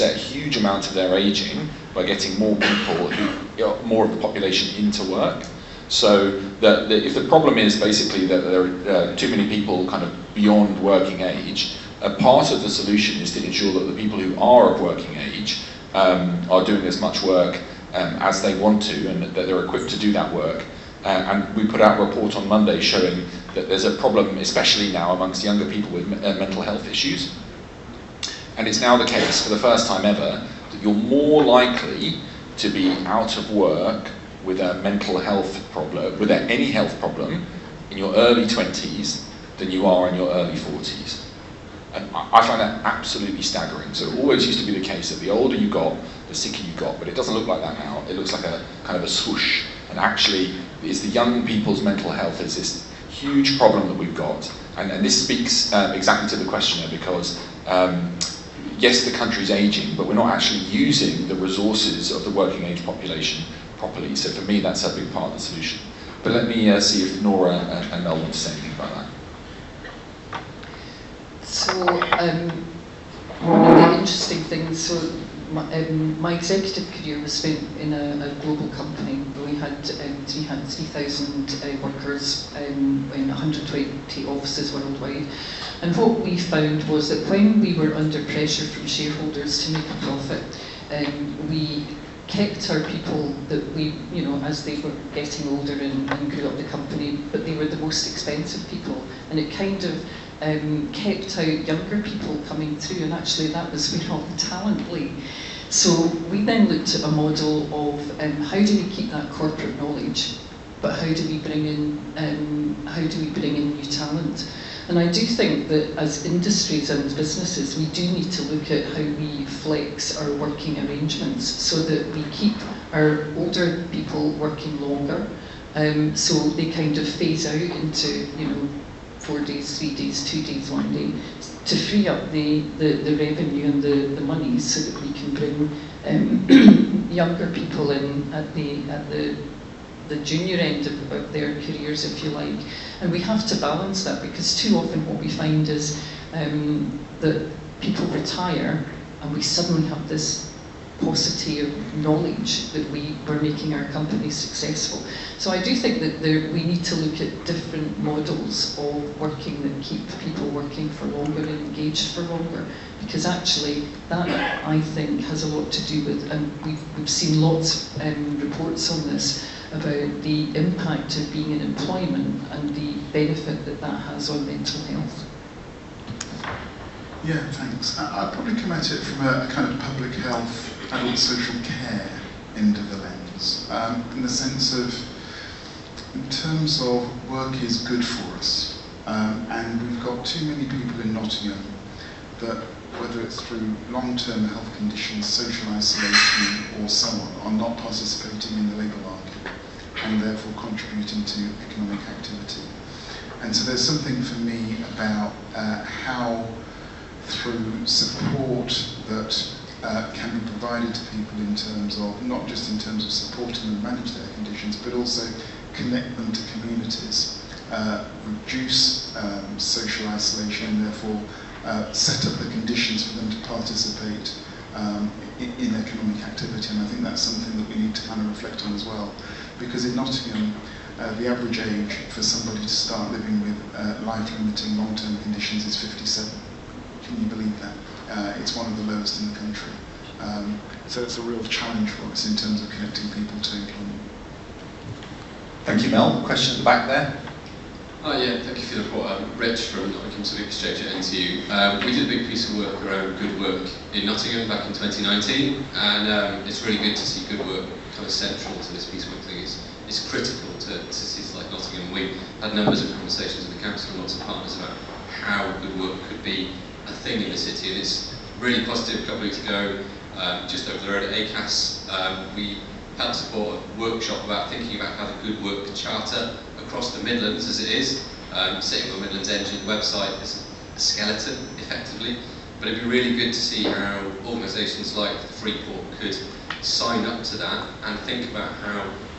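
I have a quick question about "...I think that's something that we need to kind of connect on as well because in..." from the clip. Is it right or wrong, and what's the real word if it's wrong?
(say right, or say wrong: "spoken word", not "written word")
wrong: "reflect", not "connect".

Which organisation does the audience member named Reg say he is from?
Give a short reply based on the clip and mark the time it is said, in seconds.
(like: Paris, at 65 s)
Nottingham Civic Exchange, at 249 s.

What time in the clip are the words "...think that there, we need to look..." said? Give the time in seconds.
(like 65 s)
155 s.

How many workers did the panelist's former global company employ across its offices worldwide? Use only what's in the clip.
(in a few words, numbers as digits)
3,000.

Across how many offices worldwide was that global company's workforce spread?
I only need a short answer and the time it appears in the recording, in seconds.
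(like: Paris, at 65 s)
120, at 83 s.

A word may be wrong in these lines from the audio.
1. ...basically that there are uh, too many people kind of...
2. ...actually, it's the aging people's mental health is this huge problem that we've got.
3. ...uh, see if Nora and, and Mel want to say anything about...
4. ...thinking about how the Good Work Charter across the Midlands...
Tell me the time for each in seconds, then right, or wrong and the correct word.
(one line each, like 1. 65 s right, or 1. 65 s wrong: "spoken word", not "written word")
1. 7 s right
2. 49 s wrong: "young", not "aging"
3. 66 s right
4. 274 s right.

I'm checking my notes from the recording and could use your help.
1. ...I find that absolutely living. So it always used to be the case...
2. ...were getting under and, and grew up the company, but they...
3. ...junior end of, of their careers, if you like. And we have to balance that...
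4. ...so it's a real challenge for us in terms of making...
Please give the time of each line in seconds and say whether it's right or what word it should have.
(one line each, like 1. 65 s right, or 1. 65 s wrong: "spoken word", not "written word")
1. 42 s wrong: "staggering", not "living"
2. 94 s wrong: "older", not "under"
3. 140 s right
4. 240 s wrong: "connecting", not "making".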